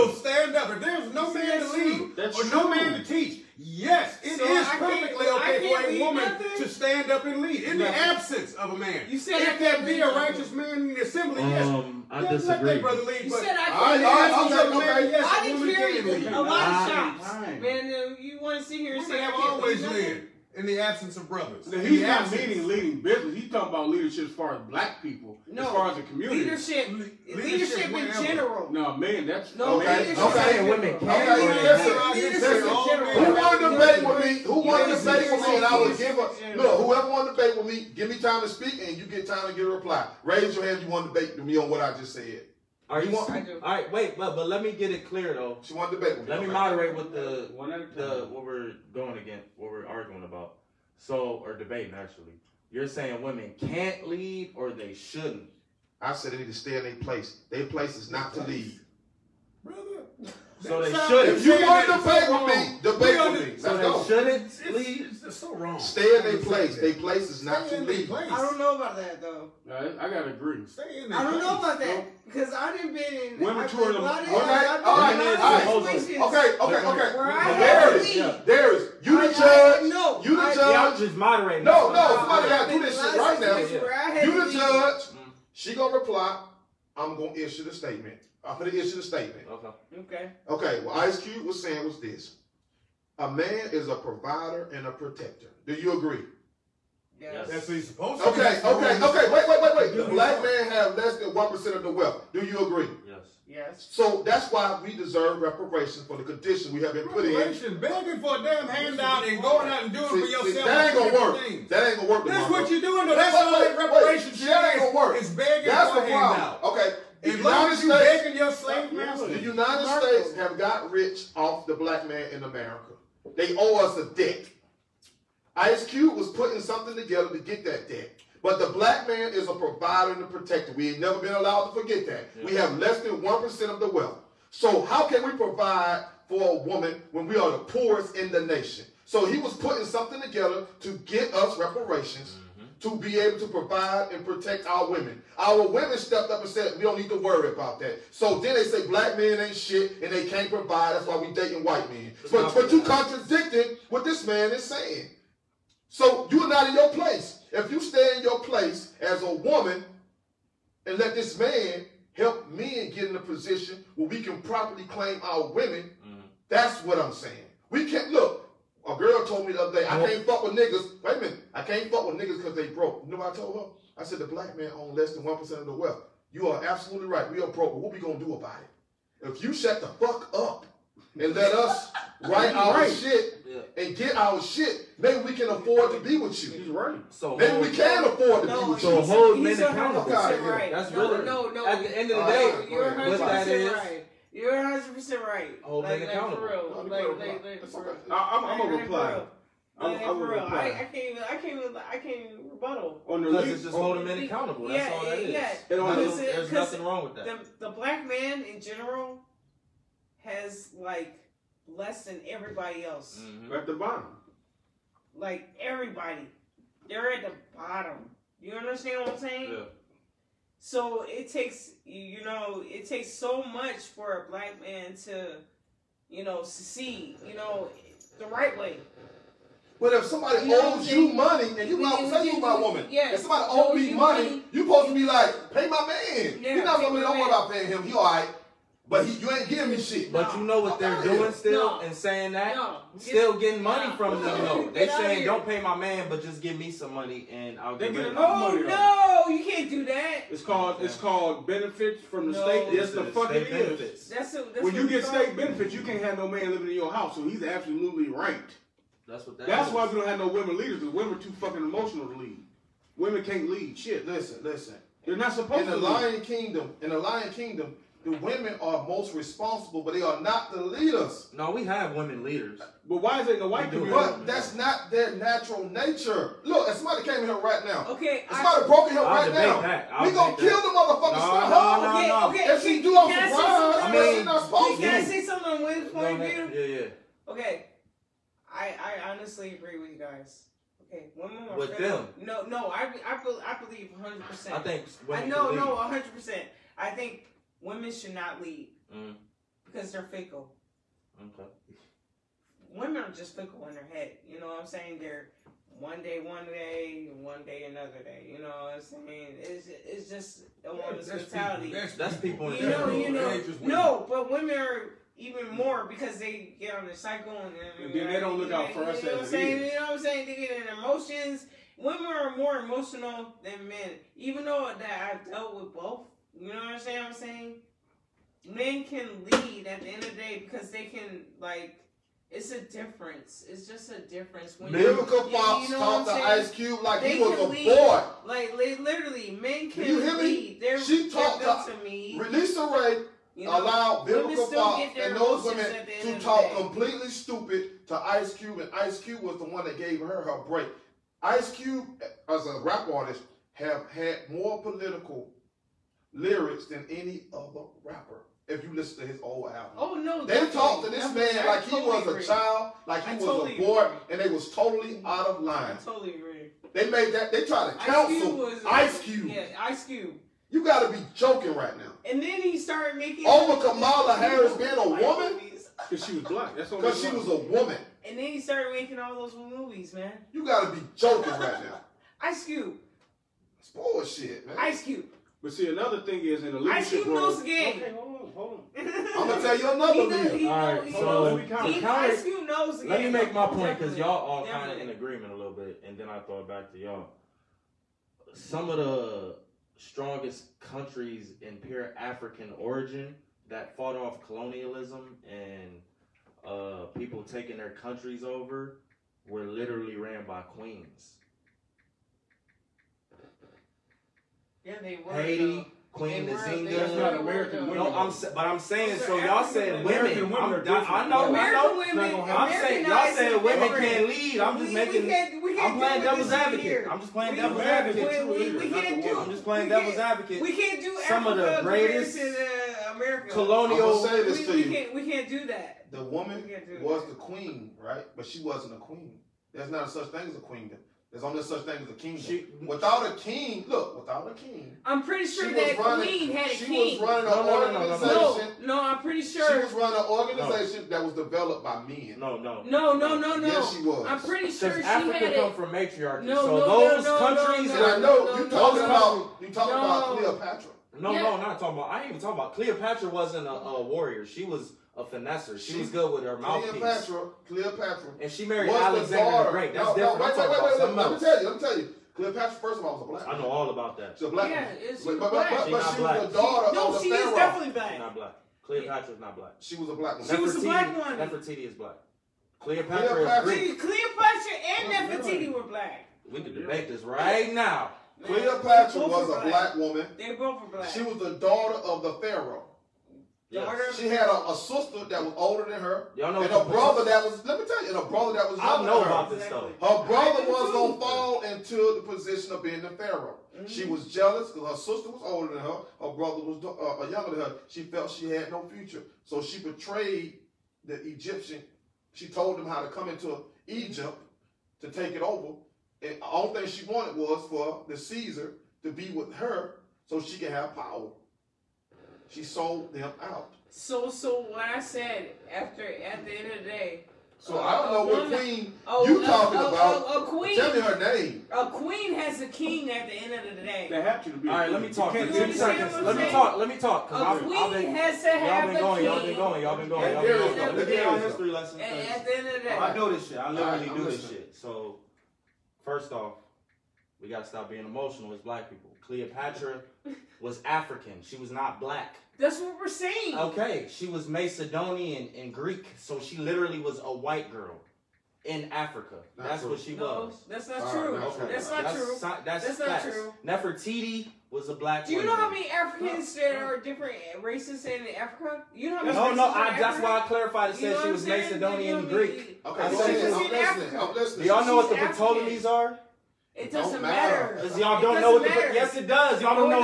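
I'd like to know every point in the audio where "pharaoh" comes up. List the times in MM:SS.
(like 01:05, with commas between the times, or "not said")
08:12, 08:22.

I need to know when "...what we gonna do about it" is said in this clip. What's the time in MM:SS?
02:57.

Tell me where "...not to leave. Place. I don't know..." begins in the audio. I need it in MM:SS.
01:07.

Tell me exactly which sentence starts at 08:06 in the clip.
We can debate this right now.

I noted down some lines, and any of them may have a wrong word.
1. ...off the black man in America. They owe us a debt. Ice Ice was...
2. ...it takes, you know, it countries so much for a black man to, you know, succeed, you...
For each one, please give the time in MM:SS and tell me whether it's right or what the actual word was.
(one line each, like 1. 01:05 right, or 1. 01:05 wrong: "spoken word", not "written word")
1. 02:01 wrong: "Cube", not "Ice"
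2. 03:41 wrong: "takes", not "countries".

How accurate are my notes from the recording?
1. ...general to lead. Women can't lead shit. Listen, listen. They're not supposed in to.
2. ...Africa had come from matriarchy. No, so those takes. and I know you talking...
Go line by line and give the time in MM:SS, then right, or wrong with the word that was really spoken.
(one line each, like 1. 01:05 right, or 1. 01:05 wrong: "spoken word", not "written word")
1. 04:21 wrong: "emotional", not "general"
2. 07:34 wrong: "countries", not "takes".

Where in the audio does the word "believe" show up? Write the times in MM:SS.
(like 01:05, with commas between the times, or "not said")
04:53.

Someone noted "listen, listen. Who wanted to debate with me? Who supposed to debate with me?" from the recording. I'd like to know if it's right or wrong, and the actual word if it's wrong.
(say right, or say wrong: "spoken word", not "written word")
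wrong: "wanted", not "supposed".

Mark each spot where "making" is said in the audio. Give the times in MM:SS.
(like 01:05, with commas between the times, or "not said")
06:12, 06:18, 07:04.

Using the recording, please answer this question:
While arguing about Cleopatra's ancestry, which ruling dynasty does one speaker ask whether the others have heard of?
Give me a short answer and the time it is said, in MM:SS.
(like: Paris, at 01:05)
Ptolemies, at 09:34.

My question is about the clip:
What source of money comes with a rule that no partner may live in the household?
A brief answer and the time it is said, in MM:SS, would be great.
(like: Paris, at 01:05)
benefits from the state, at 04:11.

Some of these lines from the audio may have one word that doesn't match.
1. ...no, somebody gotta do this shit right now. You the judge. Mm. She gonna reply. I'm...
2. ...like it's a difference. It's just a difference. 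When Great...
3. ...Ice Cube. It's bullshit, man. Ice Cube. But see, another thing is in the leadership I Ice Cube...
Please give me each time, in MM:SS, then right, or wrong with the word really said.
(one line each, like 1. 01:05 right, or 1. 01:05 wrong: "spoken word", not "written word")
1. 01:21 right
2. 05:31 wrong: "Lyrical", not "Great"
3. 06:22 right.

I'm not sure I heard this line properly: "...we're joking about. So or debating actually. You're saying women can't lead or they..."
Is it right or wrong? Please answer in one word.
wrong.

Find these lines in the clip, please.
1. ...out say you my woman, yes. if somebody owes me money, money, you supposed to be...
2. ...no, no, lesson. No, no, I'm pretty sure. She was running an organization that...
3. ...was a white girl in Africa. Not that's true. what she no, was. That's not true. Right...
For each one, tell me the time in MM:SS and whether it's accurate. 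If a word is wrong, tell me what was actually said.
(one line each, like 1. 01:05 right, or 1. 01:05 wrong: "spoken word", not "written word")
1. 03:51 right
2. 07:27 wrong: "organization", not "lesson"
3. 09:16 right.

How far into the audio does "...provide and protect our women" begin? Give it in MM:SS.
02:23.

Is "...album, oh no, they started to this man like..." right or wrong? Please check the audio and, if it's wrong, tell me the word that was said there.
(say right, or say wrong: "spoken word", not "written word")
wrong: "talked", not "started".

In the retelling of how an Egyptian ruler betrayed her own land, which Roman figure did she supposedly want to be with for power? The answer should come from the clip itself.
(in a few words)
Caesar.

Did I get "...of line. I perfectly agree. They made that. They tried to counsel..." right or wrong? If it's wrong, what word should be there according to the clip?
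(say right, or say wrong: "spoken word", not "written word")
wrong: "totally", not "perfectly".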